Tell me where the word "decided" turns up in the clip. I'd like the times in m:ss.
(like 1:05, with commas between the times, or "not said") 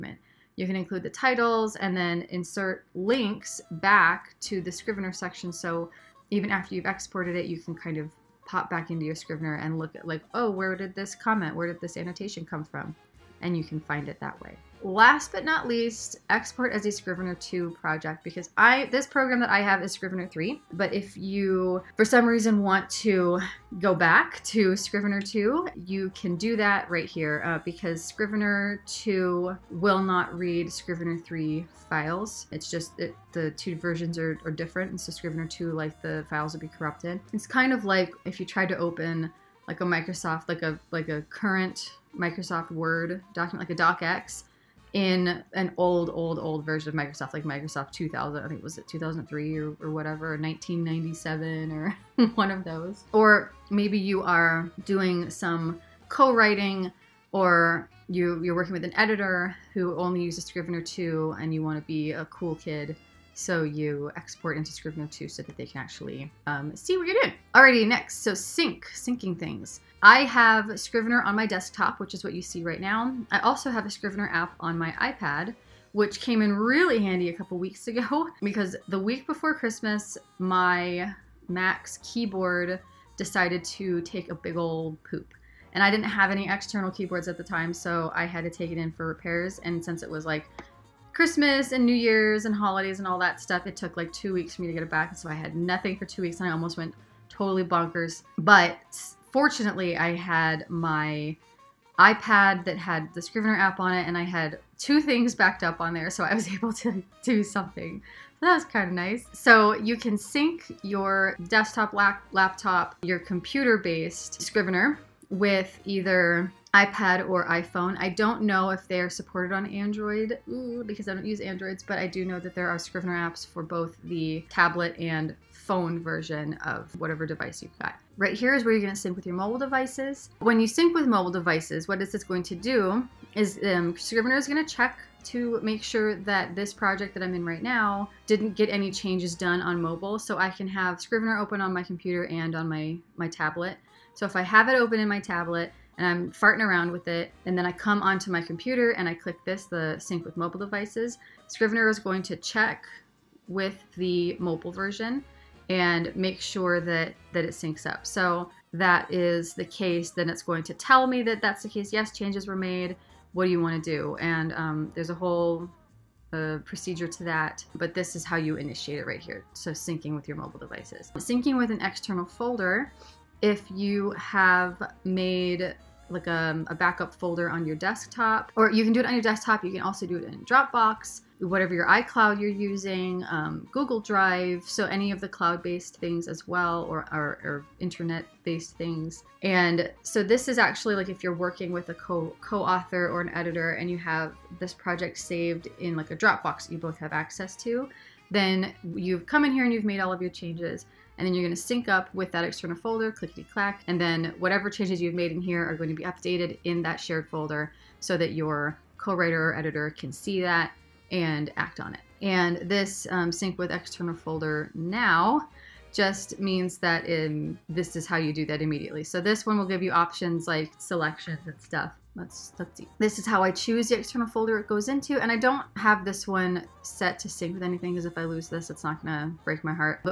1:23.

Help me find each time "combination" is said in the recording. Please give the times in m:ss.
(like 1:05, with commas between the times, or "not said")
not said.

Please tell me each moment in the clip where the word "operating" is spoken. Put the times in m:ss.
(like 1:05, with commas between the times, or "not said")
not said.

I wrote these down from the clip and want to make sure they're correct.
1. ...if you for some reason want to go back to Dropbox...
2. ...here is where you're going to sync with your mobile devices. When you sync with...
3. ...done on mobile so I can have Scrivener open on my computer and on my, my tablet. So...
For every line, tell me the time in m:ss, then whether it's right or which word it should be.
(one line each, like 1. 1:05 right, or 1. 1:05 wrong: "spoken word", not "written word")
1. 0:20 wrong: "Scrivener", not "Dropbox"
2. 2:08 right
3. 2:19 right.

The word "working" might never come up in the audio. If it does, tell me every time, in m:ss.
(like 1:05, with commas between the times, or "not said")
0:58, 3:11.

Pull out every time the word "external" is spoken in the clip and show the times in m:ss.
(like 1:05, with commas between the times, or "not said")
1:26, 2:51, 3:22, 3:33, 3:43.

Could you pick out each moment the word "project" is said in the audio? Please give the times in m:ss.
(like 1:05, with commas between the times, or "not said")
0:17, 2:16, 3:14.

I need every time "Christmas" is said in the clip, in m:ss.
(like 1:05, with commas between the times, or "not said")
1:19, 1:31.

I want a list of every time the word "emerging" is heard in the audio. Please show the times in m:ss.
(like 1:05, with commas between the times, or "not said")
not said.